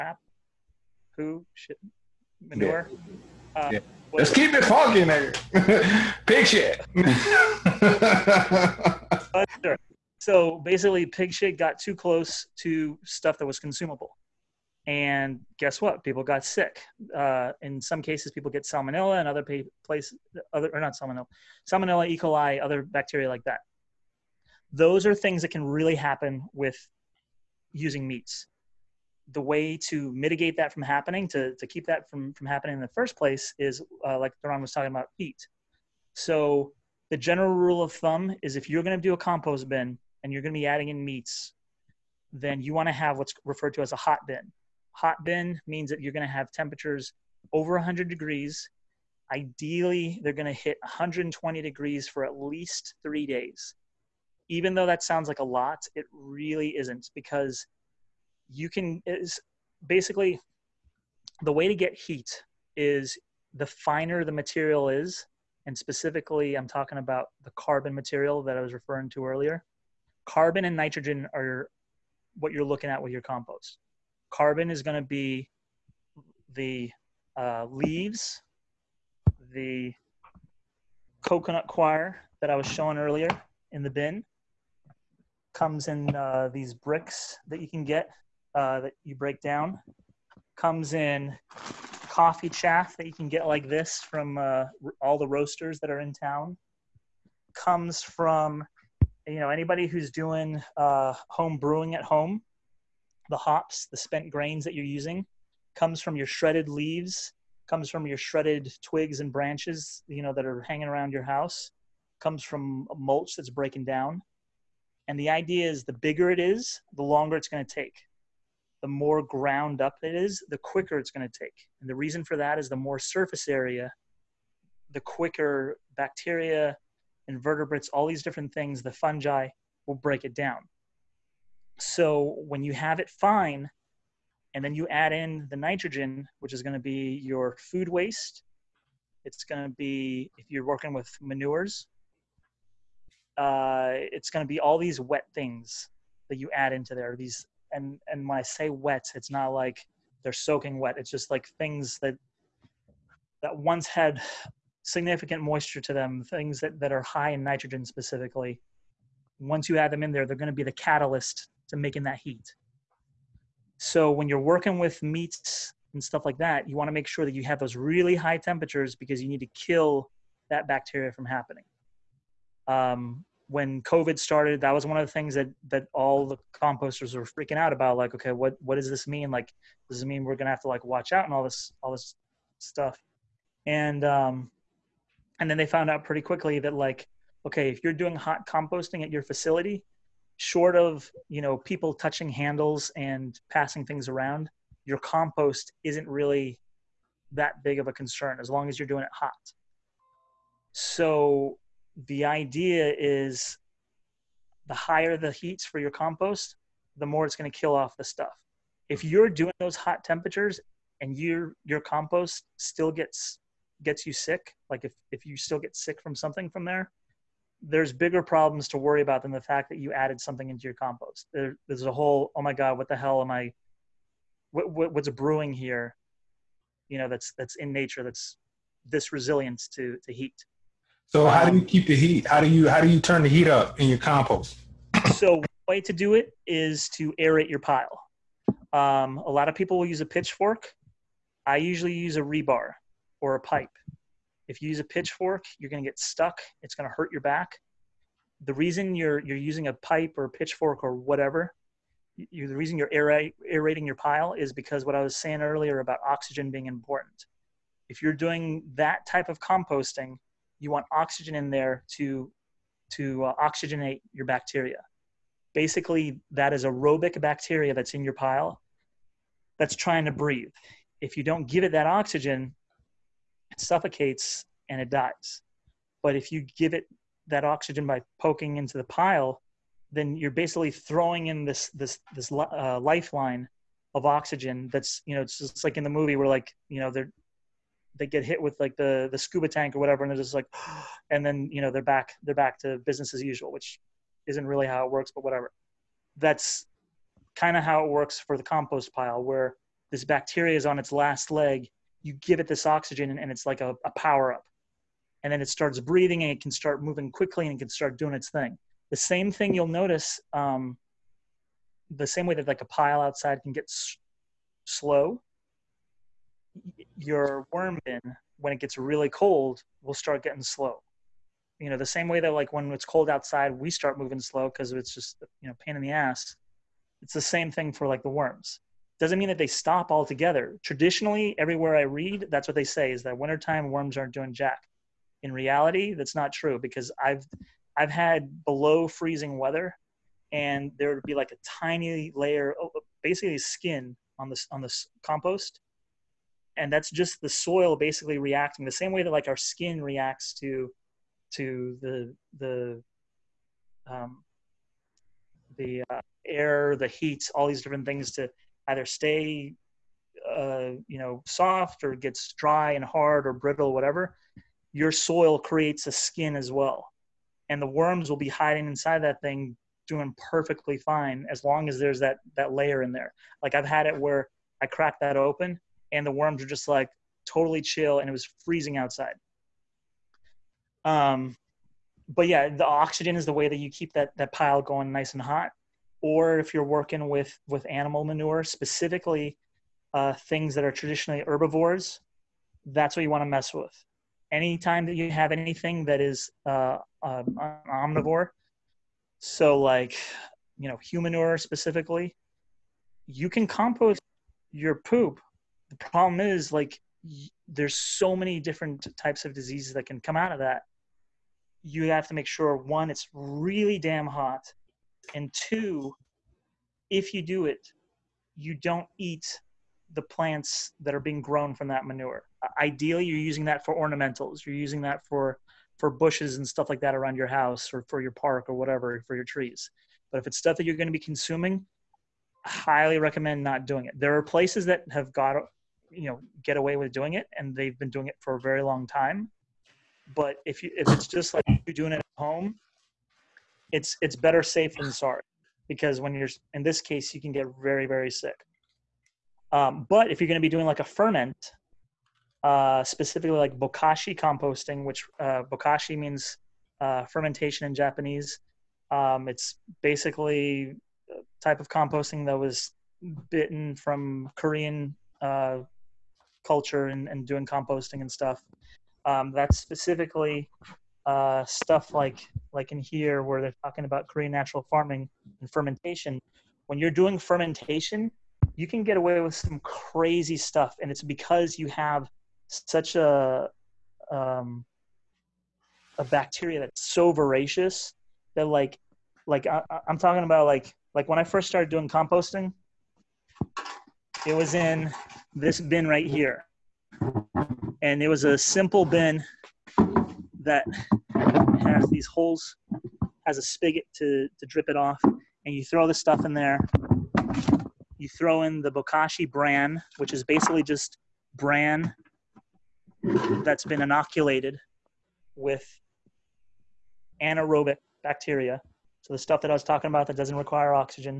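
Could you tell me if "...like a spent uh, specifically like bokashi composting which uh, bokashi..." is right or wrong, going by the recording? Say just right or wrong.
wrong.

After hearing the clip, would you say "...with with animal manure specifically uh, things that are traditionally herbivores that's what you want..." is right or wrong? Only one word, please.
right.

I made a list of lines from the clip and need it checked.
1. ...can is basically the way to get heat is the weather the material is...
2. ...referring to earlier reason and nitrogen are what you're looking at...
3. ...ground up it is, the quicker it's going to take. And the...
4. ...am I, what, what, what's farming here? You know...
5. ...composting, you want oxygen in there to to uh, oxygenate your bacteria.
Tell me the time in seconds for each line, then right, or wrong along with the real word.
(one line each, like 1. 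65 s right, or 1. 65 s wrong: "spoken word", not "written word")
1. 58 s wrong: "finer", not "weather"
2. 68 s wrong: "carbon", not "reason"
3. 119 s right
4. 223 s wrong: "brewing", not "farming"
5. 259 s right.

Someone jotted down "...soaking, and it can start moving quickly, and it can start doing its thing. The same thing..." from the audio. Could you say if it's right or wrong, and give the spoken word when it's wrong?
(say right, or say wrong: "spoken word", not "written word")
wrong: "breathing", not "soaking".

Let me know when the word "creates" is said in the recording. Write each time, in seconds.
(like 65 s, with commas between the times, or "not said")
365 s.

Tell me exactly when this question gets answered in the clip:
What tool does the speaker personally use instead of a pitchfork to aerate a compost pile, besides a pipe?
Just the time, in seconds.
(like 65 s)
242 s.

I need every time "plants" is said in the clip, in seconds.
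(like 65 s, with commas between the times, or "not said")
420 s.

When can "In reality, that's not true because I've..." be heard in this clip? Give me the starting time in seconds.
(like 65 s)
335 s.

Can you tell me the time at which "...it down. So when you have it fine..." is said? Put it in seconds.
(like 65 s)
130 s.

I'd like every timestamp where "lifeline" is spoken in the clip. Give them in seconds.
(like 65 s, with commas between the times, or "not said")
282 s.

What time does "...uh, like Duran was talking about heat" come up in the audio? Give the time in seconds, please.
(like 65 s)
34 s.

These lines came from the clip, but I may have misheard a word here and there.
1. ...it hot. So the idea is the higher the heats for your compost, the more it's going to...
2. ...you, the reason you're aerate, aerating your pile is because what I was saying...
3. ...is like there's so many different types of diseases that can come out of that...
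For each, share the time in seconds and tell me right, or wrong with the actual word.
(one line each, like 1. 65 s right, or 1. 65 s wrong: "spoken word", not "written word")
1. 199 s right
2. 252 s right
3. 406 s right.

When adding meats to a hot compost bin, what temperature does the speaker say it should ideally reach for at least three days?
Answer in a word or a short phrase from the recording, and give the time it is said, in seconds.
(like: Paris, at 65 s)
120 degrees, at 50 s.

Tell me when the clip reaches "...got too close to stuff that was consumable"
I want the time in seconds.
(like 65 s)
11 s.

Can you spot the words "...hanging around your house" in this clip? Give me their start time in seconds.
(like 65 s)
110 s.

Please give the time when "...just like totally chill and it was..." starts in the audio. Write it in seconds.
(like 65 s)
376 s.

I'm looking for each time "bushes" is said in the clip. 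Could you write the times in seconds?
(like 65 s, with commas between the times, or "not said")
425 s.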